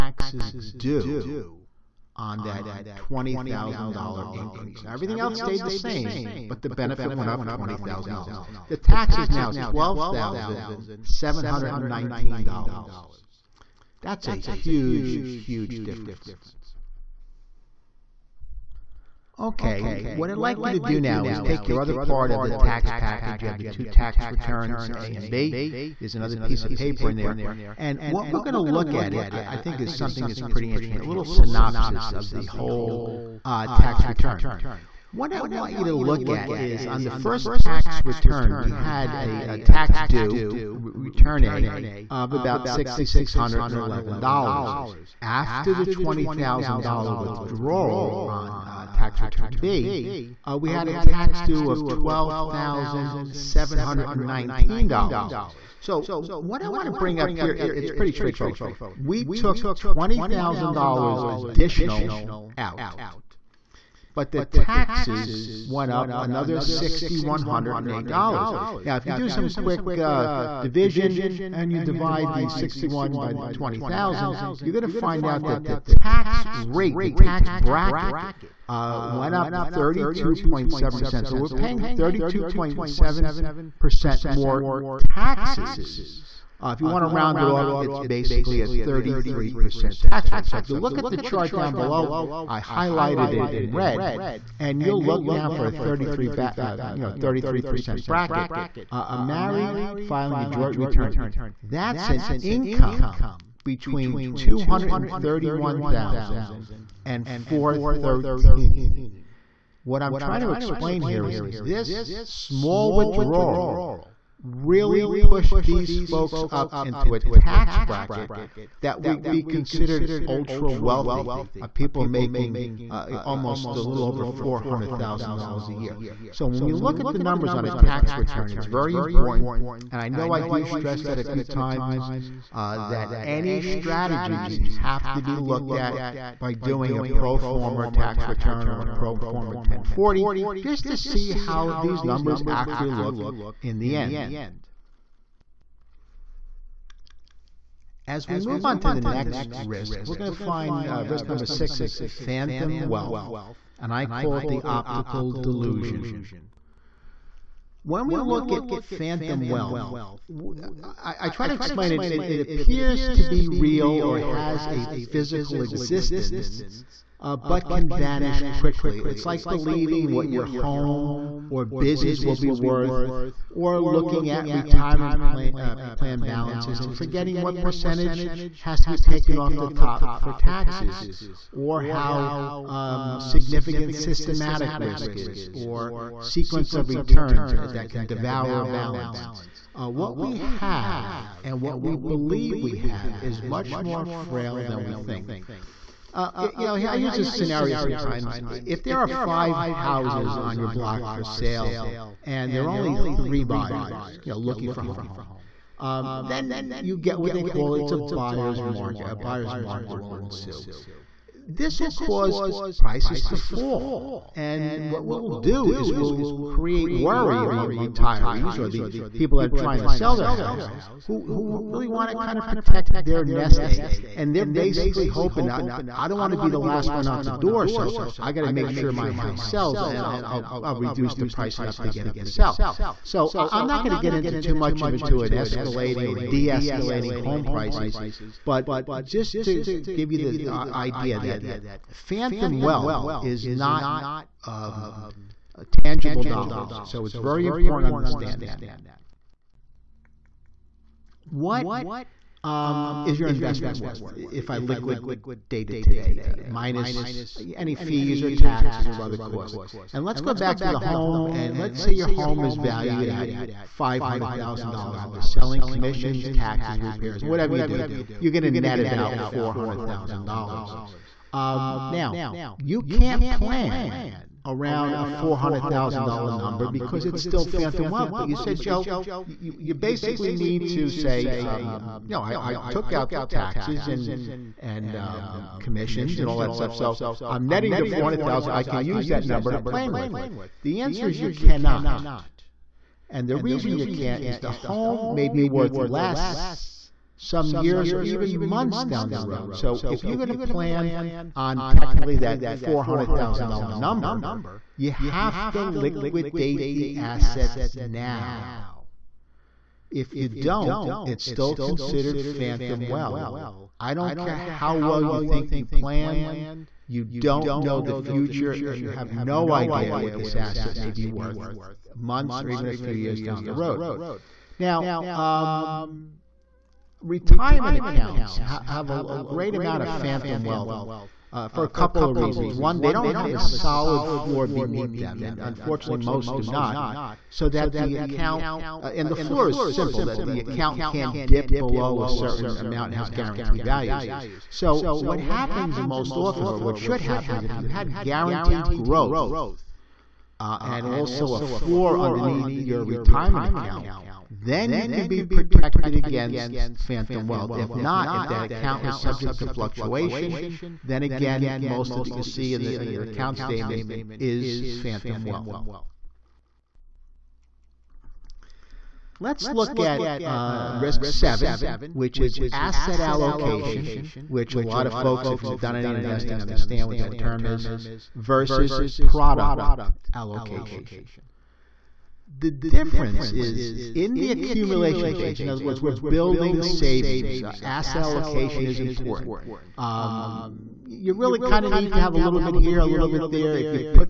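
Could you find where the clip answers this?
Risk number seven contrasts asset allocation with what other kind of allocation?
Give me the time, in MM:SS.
06:18.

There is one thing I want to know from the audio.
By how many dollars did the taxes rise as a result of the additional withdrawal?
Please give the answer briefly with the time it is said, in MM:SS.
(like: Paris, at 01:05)
$6,108, at 01:06.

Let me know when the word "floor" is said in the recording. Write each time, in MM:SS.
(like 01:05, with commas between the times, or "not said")
05:34, 05:39, 05:51.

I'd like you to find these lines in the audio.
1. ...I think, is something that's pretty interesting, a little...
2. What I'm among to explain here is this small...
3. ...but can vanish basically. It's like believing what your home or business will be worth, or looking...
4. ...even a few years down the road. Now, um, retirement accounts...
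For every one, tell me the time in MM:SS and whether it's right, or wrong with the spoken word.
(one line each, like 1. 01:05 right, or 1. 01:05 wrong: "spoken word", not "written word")
1. 00:29 right
2. 01:49 wrong: "trying", not "among"
3. 02:47 wrong: "quickly", not "basically"
4. 05:22 right.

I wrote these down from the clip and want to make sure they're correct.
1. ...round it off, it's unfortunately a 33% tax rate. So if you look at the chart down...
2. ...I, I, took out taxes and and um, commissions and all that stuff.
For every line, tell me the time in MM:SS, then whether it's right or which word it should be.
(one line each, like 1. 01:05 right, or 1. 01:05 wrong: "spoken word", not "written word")
1. 01:27 wrong: "basically", not "unfortunately"
2. 04:42 right.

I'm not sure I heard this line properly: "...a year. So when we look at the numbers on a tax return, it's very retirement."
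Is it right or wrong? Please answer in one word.
wrong.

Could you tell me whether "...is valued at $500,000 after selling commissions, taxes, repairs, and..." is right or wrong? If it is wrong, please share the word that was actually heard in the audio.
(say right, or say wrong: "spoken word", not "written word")
right.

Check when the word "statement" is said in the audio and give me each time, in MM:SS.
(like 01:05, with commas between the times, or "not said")
06:03.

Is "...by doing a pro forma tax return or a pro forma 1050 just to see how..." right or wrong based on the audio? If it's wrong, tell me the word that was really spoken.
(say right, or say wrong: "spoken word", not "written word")
wrong: "1040", not "1050".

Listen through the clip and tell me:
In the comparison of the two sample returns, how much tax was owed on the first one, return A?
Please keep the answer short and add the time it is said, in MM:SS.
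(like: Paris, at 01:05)
$6,611, at 00:42.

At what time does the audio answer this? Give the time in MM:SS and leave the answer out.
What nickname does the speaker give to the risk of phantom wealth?
02:34.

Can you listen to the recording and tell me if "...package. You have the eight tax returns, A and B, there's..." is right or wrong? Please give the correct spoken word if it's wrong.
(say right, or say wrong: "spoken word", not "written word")
wrong: "two", not "eight".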